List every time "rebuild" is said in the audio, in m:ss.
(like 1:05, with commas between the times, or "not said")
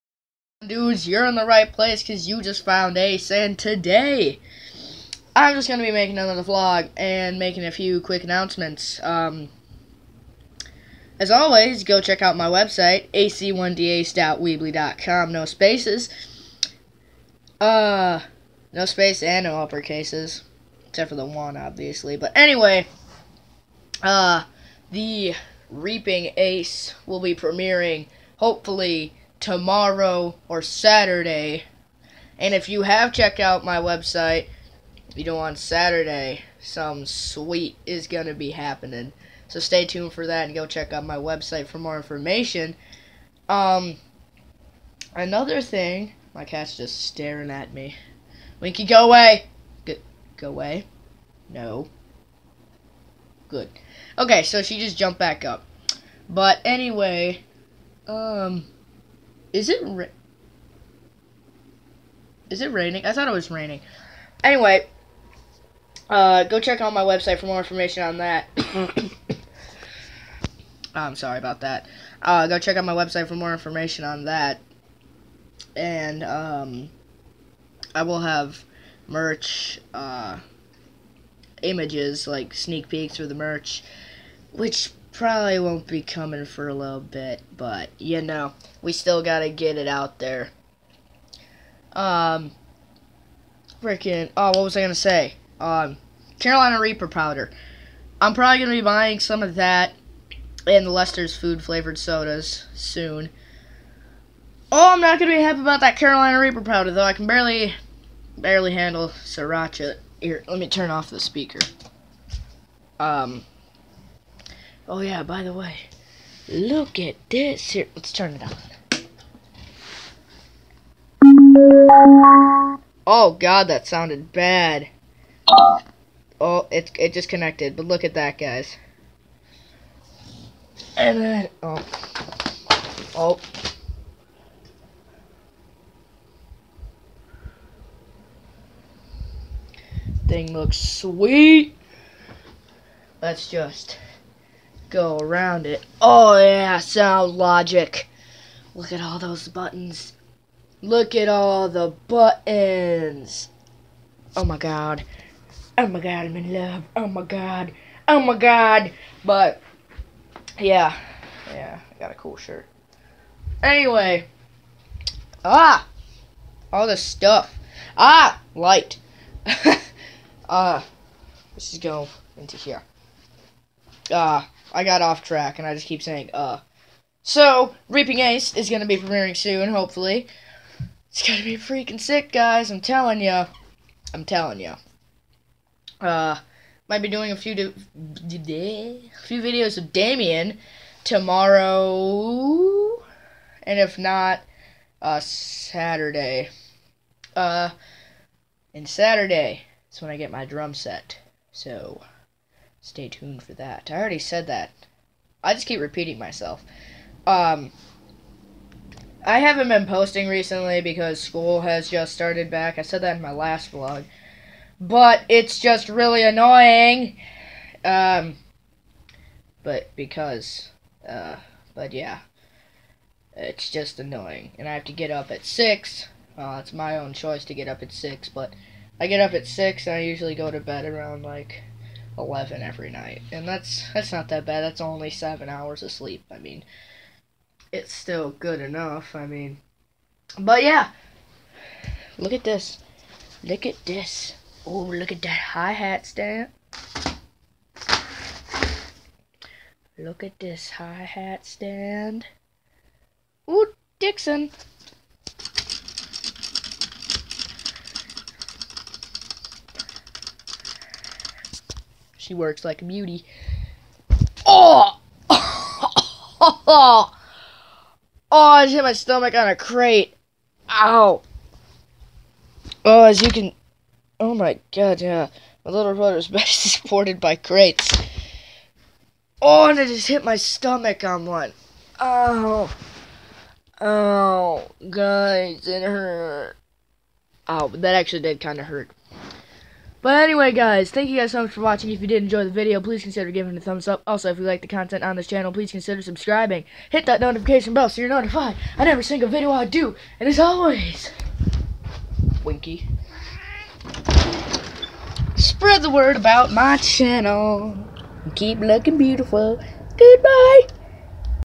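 not said.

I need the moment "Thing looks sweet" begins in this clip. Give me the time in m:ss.
2:20.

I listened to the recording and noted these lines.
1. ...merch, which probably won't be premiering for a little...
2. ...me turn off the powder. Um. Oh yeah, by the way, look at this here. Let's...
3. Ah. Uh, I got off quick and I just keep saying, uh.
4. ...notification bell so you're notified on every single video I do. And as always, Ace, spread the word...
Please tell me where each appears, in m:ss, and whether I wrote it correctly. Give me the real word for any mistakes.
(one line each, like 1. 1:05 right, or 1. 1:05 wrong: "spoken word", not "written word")
1. 1:23 wrong: "coming", not "premiering"
2. 1:50 wrong: "speaker", not "powder"
3. 2:54 wrong: "track", not "quick"
4. 4:57 wrong: "Winky", not "Ace".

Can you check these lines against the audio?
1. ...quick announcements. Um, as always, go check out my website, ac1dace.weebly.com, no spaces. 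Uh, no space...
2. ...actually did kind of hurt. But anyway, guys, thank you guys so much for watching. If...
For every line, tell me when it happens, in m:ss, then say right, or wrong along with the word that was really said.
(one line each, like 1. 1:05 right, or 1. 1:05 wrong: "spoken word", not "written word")
1. 0:07 right
2. 4:47 right.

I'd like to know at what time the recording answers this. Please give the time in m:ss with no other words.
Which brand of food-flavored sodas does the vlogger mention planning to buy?
1:40.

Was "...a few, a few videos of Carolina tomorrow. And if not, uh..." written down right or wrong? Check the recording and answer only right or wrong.
wrong.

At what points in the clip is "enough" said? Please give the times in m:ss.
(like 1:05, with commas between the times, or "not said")
3:58.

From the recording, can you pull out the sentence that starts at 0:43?
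Um, another thing, my cat's just staring at me.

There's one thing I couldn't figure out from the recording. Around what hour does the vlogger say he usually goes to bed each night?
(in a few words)
11.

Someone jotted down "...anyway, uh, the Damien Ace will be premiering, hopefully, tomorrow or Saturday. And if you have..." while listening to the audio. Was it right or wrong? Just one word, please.
wrong.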